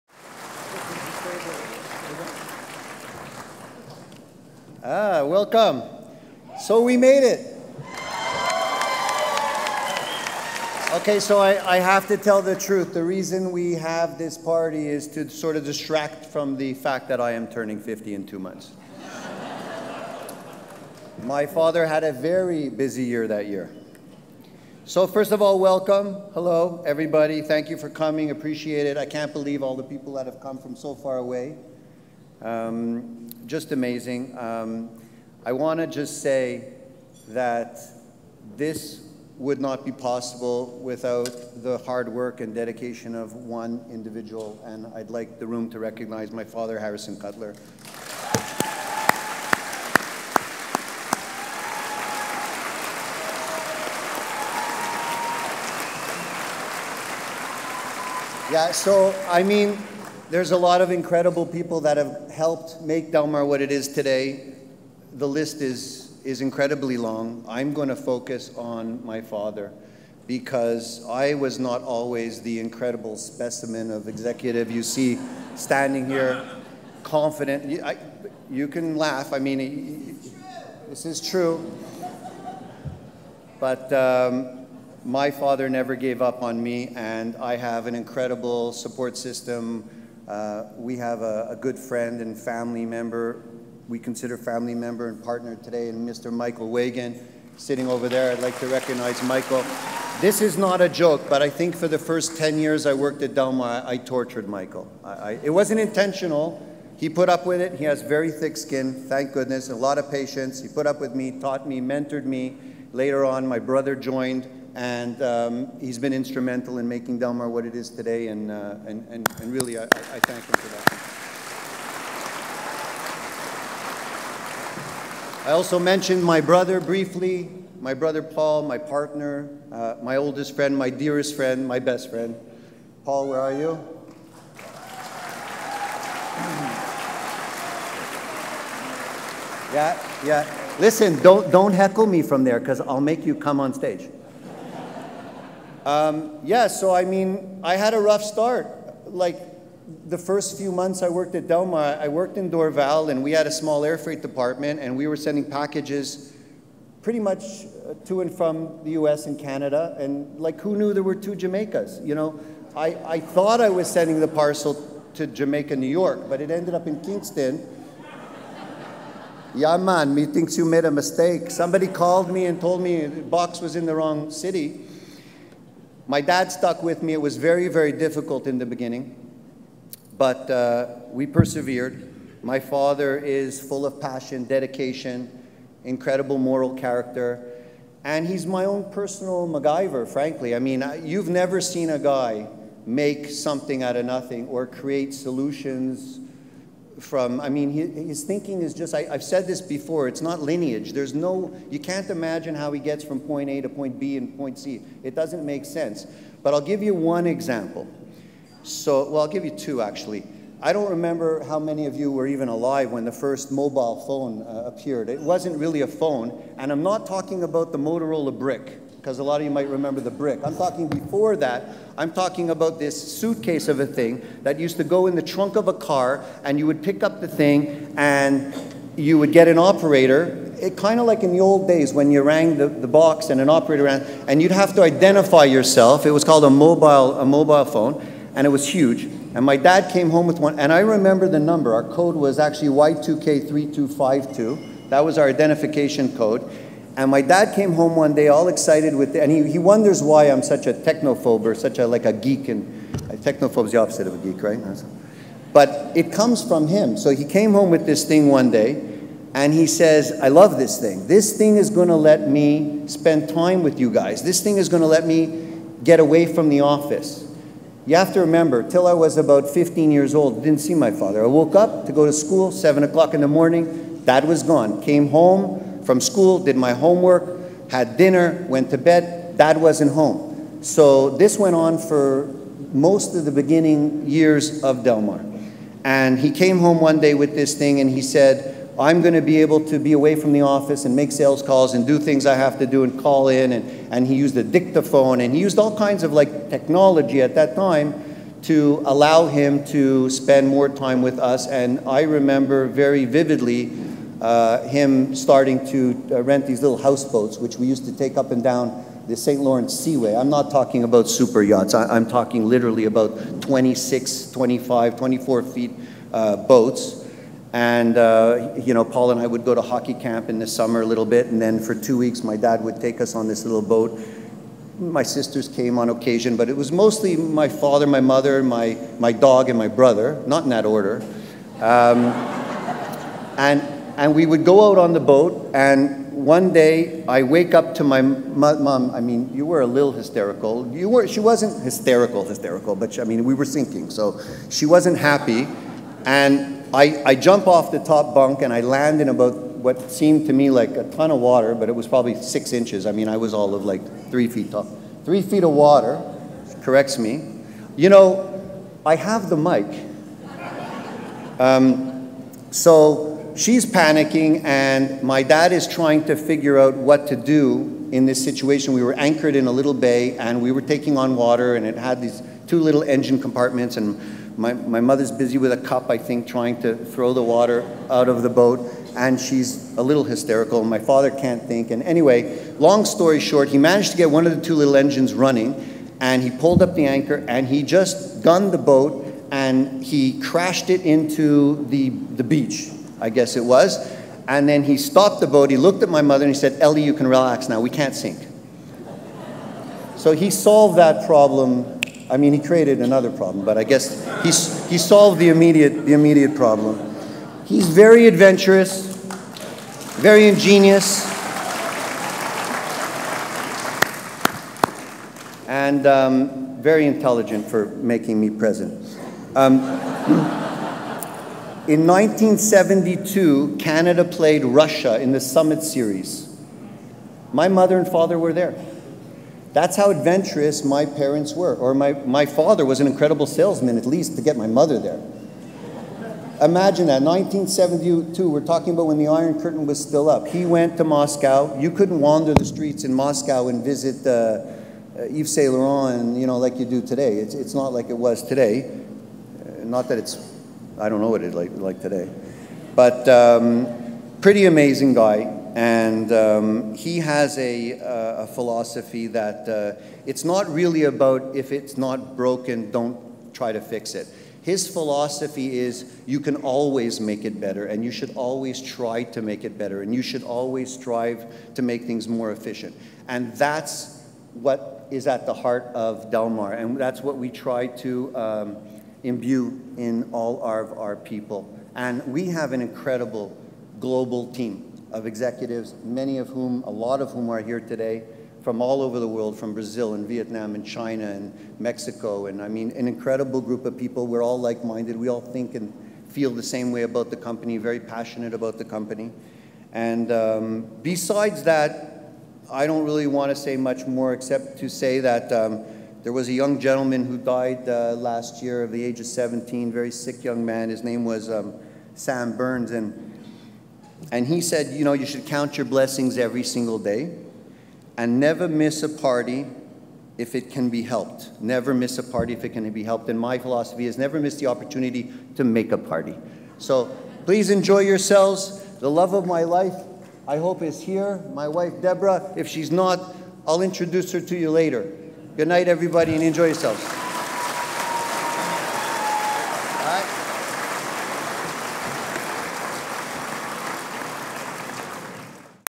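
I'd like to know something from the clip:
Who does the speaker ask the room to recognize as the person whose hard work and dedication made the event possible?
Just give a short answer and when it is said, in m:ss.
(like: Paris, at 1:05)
Harrison Cutler, at 0:46.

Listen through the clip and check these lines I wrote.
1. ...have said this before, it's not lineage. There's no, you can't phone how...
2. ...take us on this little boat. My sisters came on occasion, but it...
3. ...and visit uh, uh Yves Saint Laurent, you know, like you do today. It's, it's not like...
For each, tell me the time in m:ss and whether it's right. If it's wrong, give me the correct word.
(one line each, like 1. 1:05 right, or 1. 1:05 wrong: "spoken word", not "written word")
1. 3:19 wrong: "imagine", not "phone"
2. 5:22 right
3. 7:23 right.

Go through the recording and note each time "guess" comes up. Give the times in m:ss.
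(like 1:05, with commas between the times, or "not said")
6:33, 6:43.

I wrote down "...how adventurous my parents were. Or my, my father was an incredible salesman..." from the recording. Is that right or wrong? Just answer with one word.
right.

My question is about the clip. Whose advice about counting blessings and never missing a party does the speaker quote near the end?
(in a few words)
Sam Berns.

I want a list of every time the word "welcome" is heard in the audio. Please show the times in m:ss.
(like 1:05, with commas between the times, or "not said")
0:05, 0:25.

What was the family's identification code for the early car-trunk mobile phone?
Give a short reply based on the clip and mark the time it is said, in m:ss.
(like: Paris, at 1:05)
Y2K3252, at 4:02.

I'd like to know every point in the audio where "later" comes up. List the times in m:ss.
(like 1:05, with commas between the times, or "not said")
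1:52, 8:54.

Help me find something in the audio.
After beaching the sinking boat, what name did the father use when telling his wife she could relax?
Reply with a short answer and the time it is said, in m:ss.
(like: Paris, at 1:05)
Ellie, at 6:36.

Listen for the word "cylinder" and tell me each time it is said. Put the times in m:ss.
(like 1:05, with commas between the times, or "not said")
not said.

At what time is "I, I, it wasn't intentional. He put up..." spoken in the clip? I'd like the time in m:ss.
1:45.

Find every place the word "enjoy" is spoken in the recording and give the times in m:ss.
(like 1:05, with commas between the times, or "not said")
8:47, 8:56.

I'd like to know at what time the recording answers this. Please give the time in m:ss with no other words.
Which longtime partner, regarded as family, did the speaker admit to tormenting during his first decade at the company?
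1:36.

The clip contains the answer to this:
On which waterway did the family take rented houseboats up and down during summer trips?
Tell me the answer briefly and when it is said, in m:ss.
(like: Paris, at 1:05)
St. Lawrence Seaway, at 5:09.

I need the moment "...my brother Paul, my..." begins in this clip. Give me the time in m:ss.
2:07.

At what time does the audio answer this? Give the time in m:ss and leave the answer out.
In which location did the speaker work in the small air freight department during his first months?
2:32.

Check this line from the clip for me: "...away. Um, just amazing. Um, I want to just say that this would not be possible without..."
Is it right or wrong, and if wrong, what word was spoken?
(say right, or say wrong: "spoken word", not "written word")
right.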